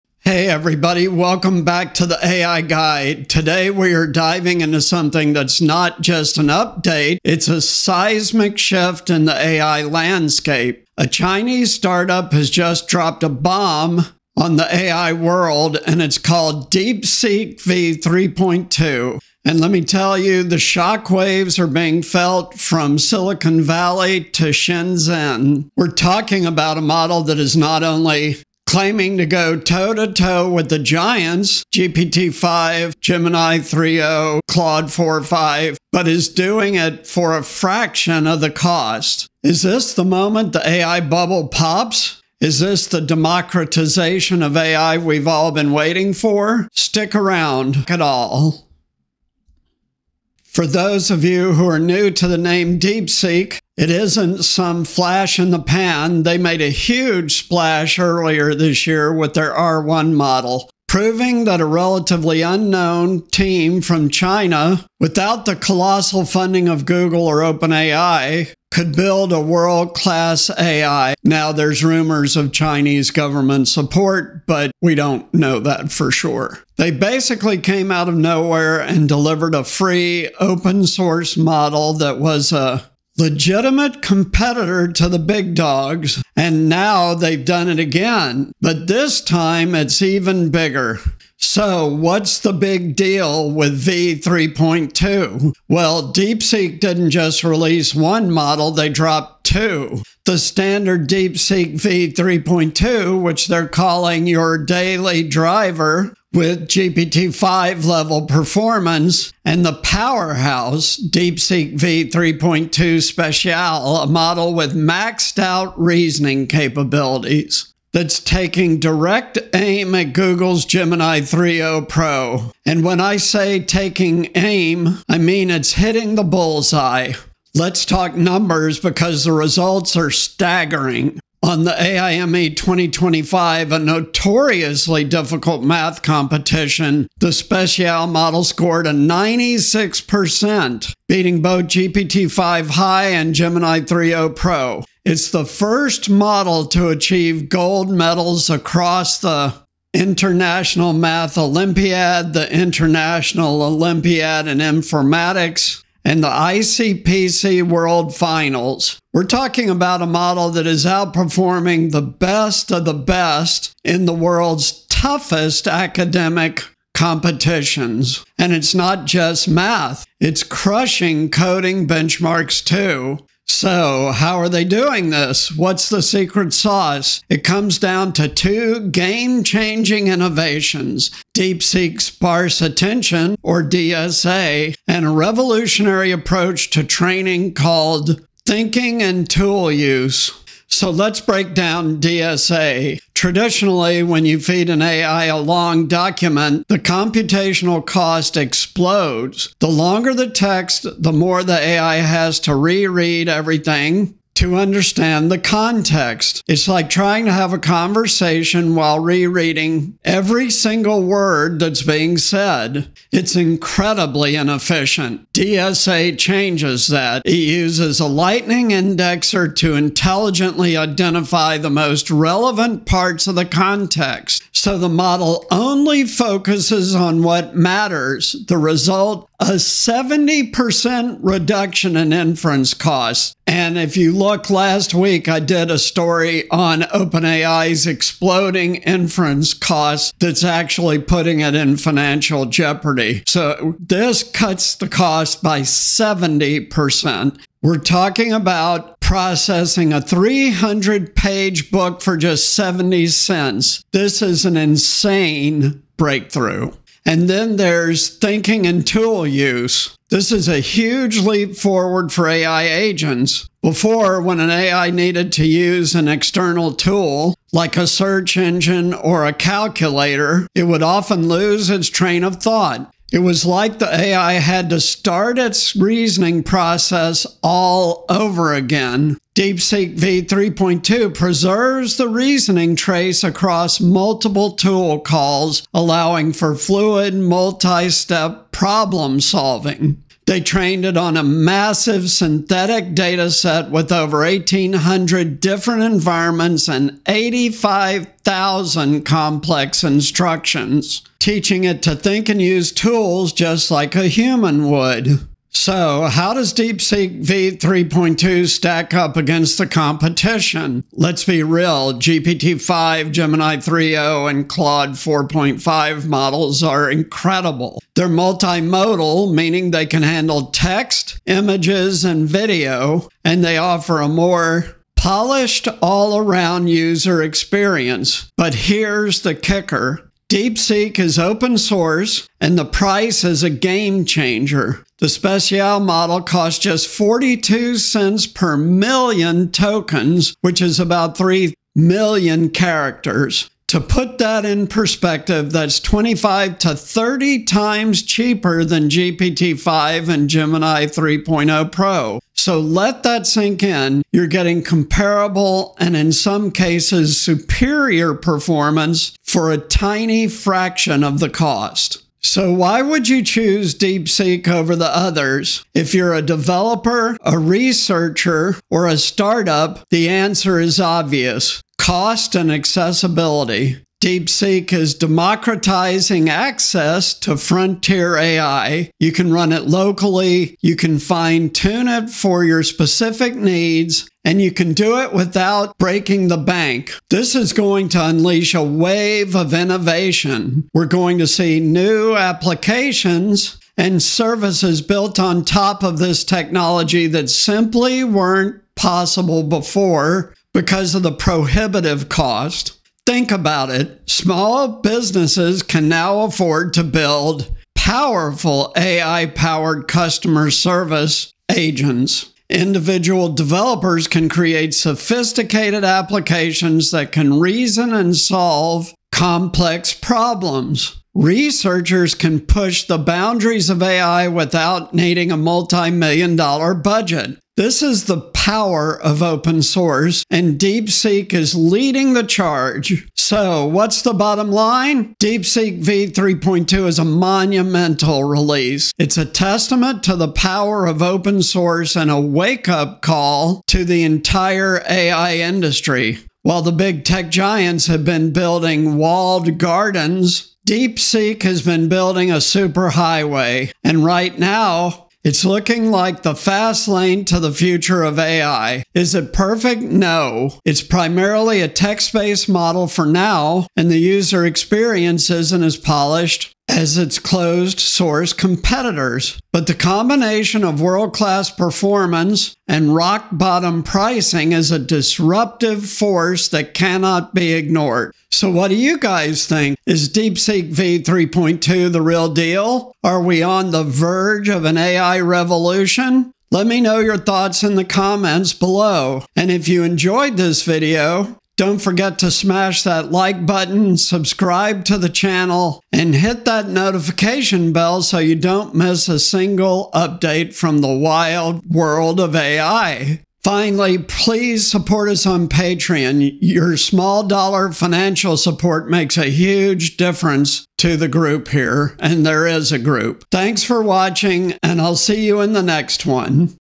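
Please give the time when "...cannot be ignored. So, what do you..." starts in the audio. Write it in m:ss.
7:56.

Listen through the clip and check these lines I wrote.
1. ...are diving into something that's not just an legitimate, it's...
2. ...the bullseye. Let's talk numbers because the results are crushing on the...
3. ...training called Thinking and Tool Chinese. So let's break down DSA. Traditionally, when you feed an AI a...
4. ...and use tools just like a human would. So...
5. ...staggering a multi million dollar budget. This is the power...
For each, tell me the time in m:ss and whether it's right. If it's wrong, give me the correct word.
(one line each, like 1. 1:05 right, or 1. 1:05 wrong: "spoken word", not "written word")
1. 0:03 wrong: "update", not "legitimate"
2. 2:06 wrong: "staggering", not "crushing"
3. 3:06 wrong: "Use", not "Chinese"
4. 5:02 right
5. 7:04 wrong: "needing", not "staggering".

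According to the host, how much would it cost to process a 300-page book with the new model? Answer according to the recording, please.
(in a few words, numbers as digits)
70 cents.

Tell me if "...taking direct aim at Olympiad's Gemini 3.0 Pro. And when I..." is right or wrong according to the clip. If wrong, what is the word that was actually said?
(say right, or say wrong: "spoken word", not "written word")
wrong: "Google", not "Olympiad".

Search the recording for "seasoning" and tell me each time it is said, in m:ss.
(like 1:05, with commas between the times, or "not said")
not said.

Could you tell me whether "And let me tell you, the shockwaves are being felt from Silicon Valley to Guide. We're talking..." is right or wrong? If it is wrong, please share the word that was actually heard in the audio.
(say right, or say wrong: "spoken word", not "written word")
wrong: "Shenzhen", not "Guide".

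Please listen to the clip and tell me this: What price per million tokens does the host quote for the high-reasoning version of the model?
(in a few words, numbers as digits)
42 cents.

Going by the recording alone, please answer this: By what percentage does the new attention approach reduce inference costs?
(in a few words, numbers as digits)
70%.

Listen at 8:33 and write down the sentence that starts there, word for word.
Thanks for watching, and I'll see you in the next one.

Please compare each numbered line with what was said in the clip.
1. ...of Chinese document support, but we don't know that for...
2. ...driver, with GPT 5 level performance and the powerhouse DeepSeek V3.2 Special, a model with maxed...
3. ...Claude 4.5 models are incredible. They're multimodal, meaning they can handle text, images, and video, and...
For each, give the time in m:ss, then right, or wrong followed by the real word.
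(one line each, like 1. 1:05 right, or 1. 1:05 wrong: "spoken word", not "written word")
1. 1:12 wrong: "government", not "document"
2. 1:45 right
3. 5:14 right.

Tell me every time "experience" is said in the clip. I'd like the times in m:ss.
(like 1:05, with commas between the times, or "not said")
5:27, 7:44.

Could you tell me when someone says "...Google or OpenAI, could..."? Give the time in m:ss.
1:06.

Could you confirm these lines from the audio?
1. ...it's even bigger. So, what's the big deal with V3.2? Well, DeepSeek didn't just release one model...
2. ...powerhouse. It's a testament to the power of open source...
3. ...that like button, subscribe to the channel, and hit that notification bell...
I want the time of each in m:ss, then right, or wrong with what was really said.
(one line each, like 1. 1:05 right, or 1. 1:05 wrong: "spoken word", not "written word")
1. 1:29 right
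2. 7:18 wrong: "release", not "powerhouse"
3. 8:12 right.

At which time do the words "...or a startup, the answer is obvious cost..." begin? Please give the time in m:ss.
6:08.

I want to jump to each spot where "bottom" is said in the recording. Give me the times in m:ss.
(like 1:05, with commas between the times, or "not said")
7:14, 7:53.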